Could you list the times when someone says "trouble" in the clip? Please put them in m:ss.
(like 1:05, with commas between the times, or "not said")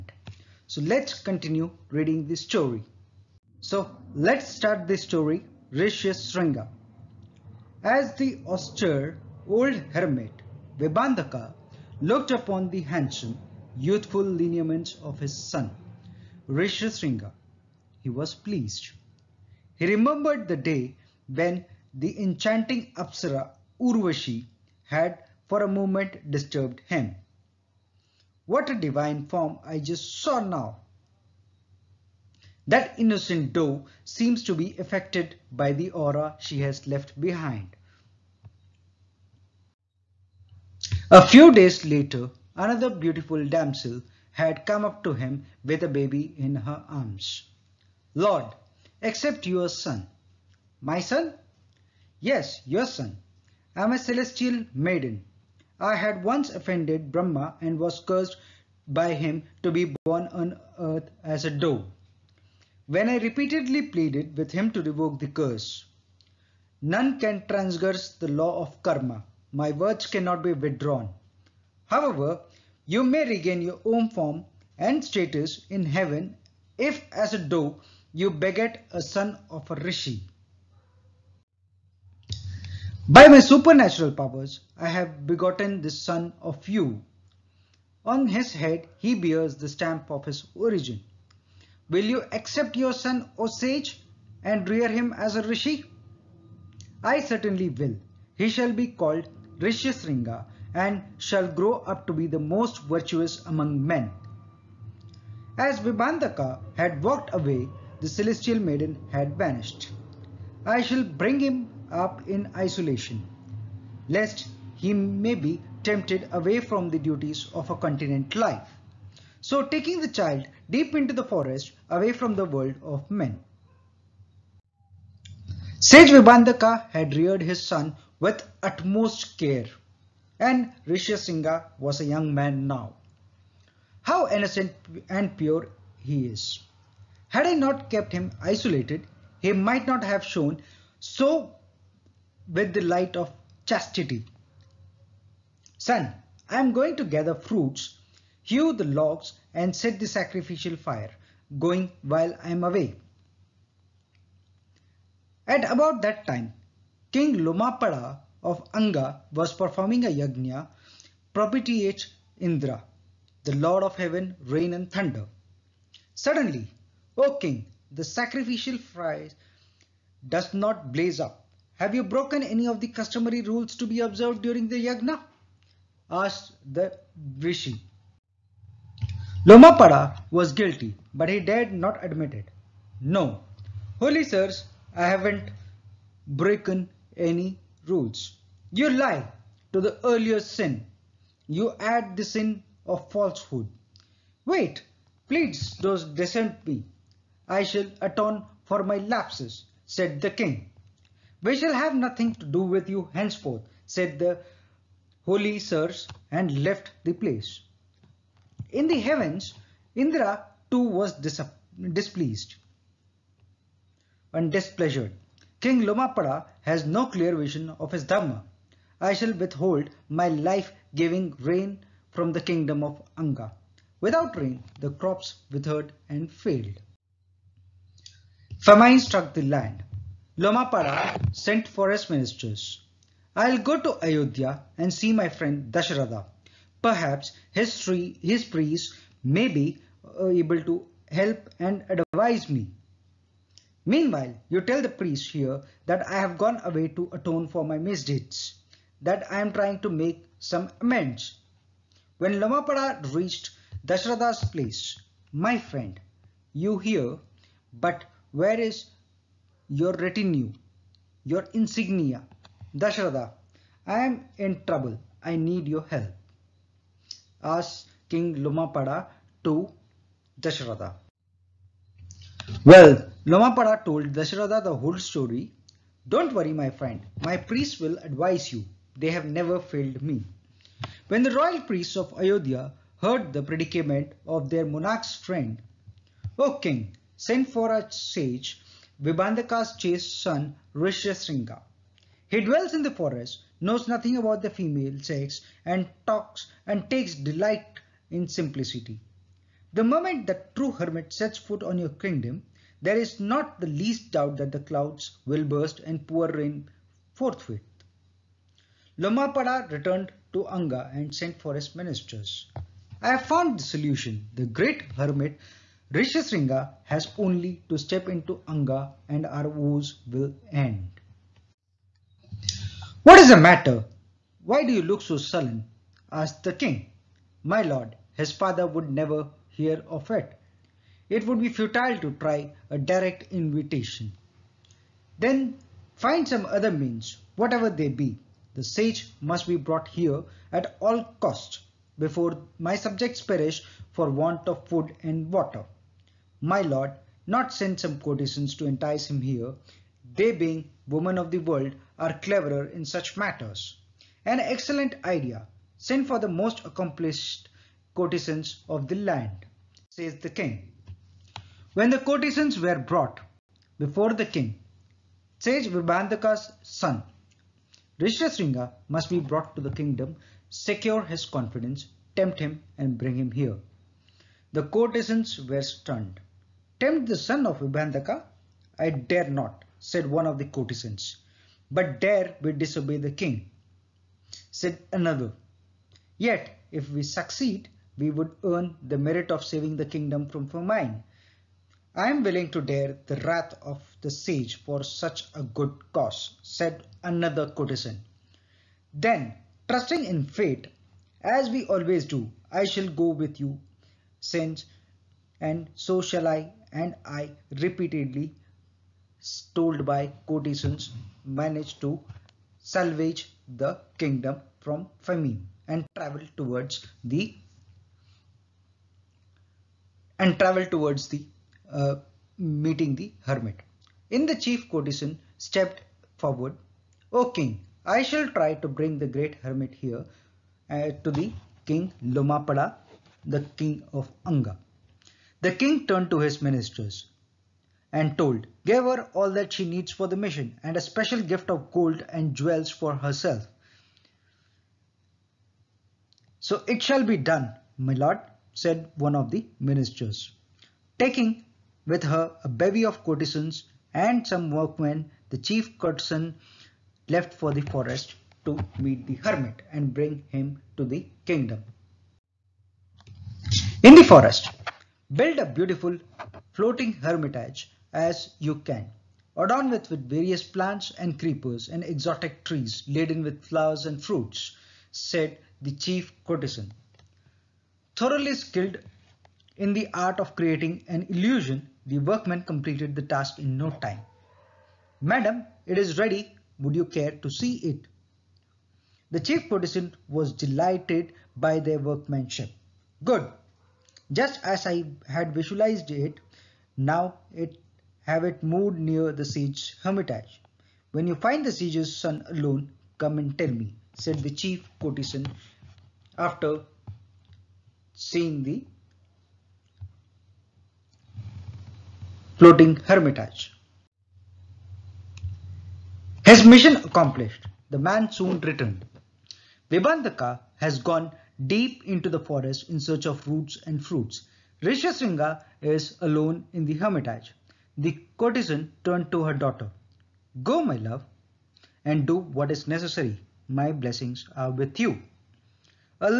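4:24.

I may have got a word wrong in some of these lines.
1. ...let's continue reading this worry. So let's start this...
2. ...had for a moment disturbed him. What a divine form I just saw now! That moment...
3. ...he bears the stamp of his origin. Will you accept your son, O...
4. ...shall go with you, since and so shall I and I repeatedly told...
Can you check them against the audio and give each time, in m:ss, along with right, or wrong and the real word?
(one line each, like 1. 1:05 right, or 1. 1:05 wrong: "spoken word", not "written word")
1. 0:00 wrong: "story", not "worry"
2. 0:24 wrong: "innocent", not "moment"
3. 1:28 right
4. 6:42 right.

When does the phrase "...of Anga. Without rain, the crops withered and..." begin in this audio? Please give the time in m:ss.
3:42.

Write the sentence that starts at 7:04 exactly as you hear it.
In the chief courtesan stepped forward.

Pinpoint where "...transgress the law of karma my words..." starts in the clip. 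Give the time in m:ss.
1:07.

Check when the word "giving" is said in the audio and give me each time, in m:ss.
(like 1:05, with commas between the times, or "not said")
3:40.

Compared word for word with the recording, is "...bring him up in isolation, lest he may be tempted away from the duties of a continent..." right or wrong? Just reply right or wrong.
right.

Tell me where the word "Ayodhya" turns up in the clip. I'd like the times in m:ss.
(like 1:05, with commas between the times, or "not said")
3:54, 4:42.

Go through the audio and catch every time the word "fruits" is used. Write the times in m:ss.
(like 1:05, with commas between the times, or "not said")
2:27, 7:54, 8:43.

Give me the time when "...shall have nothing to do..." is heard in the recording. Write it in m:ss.
3:21.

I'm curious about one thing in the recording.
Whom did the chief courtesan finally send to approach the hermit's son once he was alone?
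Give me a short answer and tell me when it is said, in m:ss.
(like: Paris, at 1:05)
Her daughter, at 8:49.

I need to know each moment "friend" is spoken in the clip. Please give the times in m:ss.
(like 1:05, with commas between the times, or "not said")
3:55, 4:15, 4:36, 4:45.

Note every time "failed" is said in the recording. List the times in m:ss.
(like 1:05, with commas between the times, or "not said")
3:46, 4:39.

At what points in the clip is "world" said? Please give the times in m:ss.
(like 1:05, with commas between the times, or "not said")
2:02, 5:51.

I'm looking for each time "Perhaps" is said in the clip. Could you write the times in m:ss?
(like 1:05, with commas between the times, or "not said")
3:56.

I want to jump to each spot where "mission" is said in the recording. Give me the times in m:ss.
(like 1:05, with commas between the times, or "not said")
7:20, 8:36.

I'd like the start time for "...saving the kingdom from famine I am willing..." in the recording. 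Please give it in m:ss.
6:29.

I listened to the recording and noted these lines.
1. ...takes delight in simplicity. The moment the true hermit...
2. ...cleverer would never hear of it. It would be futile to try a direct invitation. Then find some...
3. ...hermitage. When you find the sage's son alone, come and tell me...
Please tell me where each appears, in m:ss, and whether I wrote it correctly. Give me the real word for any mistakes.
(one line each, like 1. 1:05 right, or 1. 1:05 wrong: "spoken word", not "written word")
1. 4:56 right
2. 5:28 wrong: "father", not "cleverer"
3. 8:19 right.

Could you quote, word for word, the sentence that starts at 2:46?
Suddenly, O king, the sacrificial fire does not blaze up.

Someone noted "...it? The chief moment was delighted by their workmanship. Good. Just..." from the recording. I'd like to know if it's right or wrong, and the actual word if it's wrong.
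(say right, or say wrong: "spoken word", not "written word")
wrong: "protestant", not "moment".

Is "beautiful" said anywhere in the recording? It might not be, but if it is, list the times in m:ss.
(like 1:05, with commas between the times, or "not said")
0:42, 7:45.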